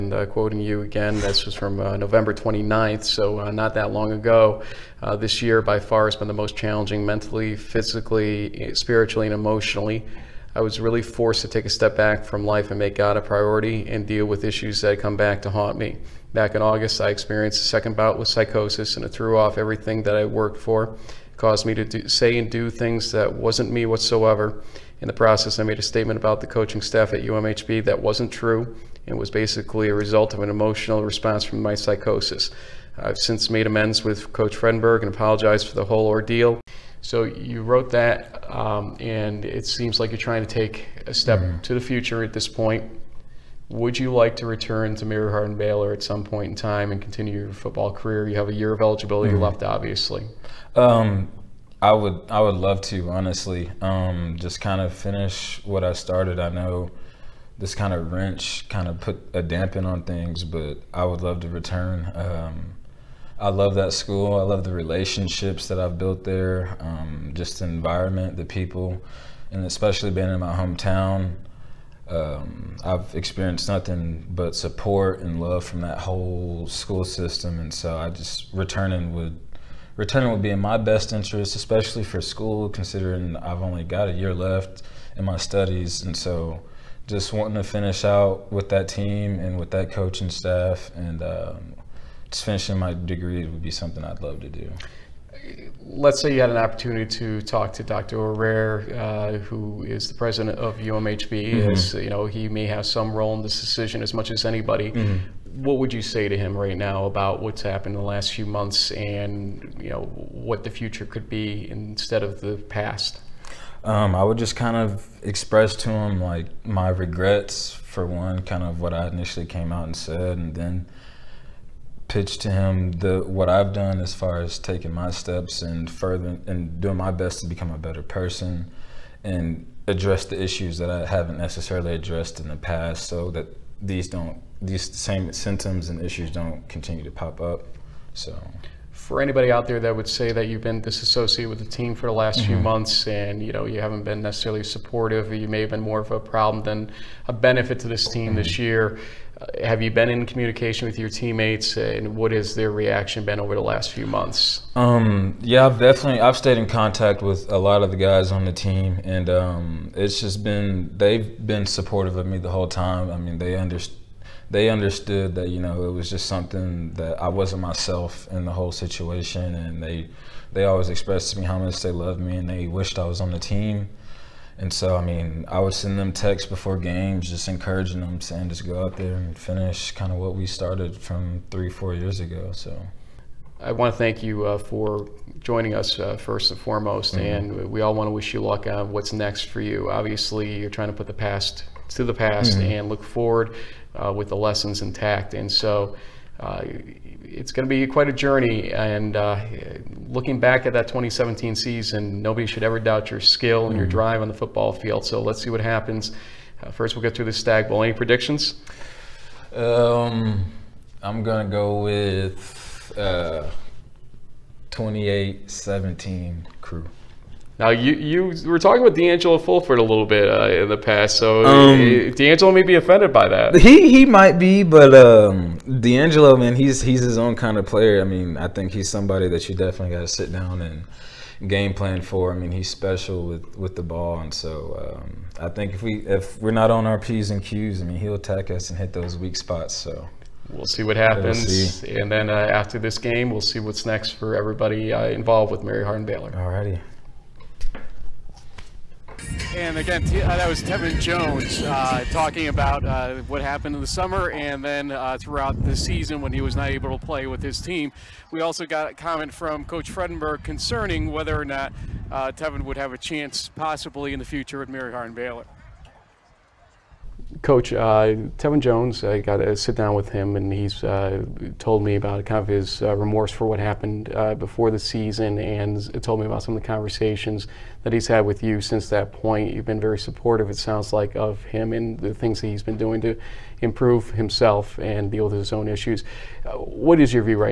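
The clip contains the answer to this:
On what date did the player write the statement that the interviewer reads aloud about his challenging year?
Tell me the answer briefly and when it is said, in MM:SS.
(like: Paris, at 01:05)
November 29, at 00:01.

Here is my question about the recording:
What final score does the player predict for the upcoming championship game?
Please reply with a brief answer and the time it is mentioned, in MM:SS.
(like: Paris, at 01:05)
28-17, at 03:34.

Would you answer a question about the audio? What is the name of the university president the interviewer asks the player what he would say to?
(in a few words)
Dr. O'Rear.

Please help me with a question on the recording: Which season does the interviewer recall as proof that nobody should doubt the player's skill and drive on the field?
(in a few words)
2017.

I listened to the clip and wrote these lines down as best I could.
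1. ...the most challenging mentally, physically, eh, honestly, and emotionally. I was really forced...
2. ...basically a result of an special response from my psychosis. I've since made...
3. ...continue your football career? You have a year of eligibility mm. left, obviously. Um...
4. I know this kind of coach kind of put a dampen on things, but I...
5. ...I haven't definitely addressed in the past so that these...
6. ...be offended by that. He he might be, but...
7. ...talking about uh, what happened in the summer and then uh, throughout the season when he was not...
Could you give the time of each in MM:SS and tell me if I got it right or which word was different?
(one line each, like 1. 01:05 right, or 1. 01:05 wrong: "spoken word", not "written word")
1. 00:06 wrong: "spiritually", not "honestly"
2. 00:29 wrong: "emotional", not "special"
3. 00:47 right
4. 00:56 wrong: "wrench", not "coach"
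5. 02:10 wrong: "necessarily", not "definitely"
6. 03:42 right
7. 04:12 right.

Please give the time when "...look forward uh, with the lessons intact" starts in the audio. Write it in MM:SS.
03:12.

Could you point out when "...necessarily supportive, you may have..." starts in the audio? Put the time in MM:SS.
02:24.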